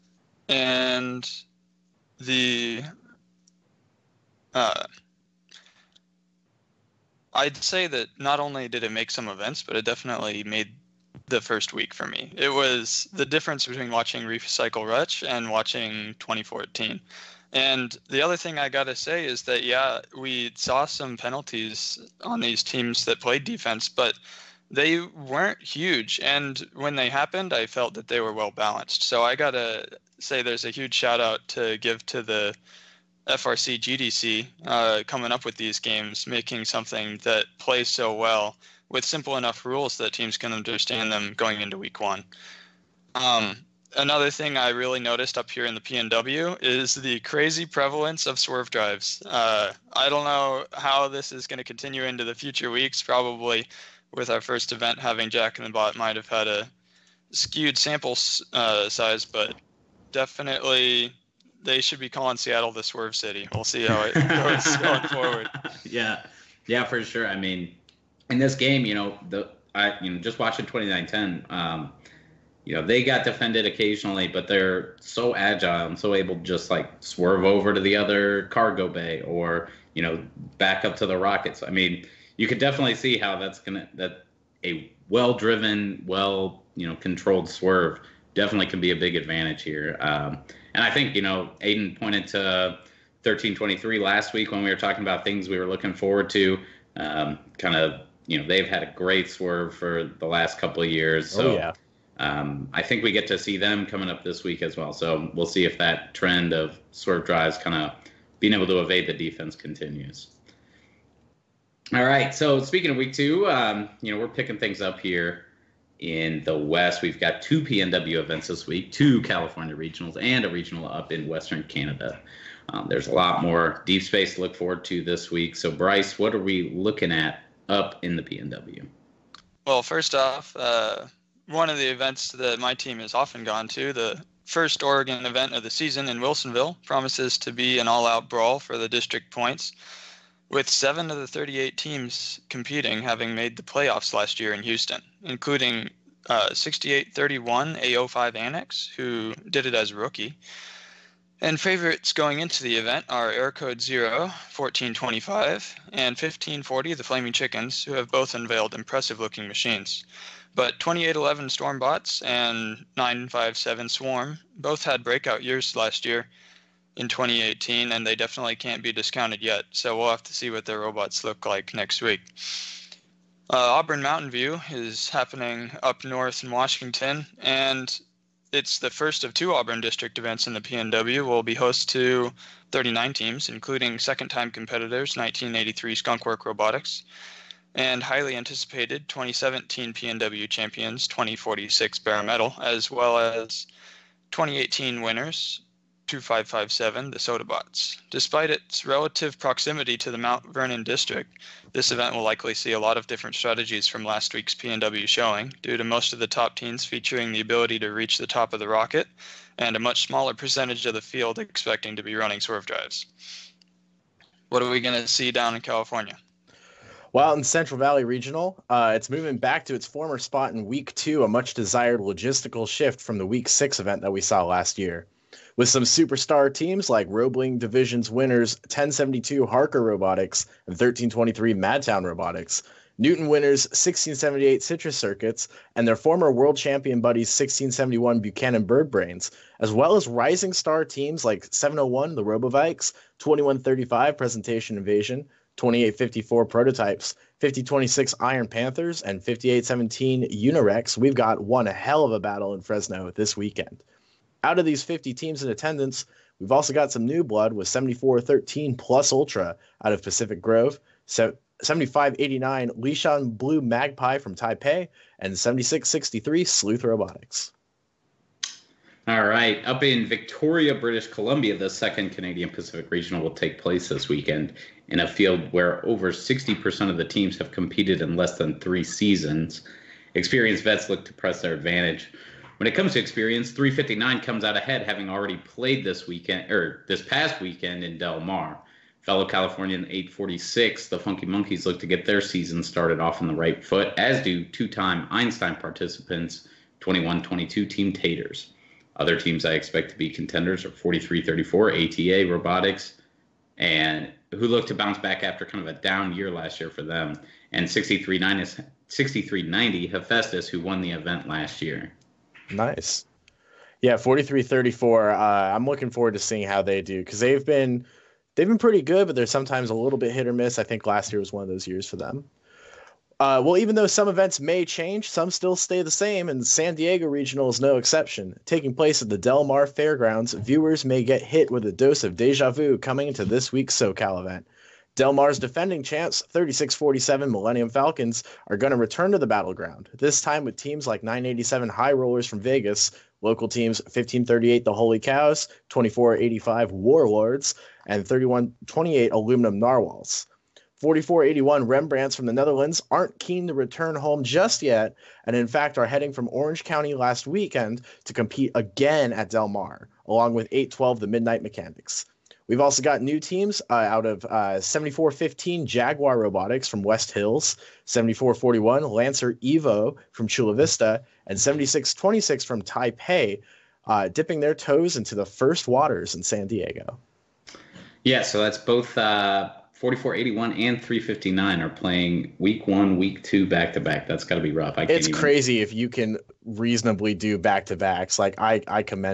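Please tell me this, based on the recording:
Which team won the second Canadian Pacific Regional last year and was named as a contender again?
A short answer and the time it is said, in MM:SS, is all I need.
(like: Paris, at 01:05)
6390 Hephaestus, at 05:07.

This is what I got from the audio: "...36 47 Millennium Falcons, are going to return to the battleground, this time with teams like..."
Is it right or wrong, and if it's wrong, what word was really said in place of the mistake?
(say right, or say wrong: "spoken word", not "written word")
right.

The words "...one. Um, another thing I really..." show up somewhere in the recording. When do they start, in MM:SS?
00:42.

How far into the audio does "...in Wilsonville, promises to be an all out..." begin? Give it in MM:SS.
02:16.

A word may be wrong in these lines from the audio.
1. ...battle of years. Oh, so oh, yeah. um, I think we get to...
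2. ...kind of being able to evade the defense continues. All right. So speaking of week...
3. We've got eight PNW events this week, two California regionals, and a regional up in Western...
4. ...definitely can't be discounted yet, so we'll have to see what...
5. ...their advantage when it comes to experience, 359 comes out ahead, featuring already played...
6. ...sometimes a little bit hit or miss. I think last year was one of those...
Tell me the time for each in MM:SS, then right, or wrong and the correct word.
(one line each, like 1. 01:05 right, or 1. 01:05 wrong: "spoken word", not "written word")
1. 01:40 wrong: "couple", not "battle"
2. 01:47 right
3. 01:57 wrong: "two", not "eight"
4. 02:48 right
5. 04:41 wrong: "having", not "featuring"
6. 05:19 right.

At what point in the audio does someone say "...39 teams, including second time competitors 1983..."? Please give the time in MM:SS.
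03:02.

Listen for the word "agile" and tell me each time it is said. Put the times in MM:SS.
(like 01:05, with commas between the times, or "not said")
01:15.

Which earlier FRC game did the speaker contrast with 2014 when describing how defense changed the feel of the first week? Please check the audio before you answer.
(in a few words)
Recycle Rush.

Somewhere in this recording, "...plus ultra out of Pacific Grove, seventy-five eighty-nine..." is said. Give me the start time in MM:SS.
04:18.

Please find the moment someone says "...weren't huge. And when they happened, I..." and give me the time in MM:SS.
00:25.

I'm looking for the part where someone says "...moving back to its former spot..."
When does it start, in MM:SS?
03:39.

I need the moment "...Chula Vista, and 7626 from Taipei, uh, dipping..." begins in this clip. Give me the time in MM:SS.
06:10.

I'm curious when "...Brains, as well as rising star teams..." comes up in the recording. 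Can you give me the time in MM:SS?
03:58.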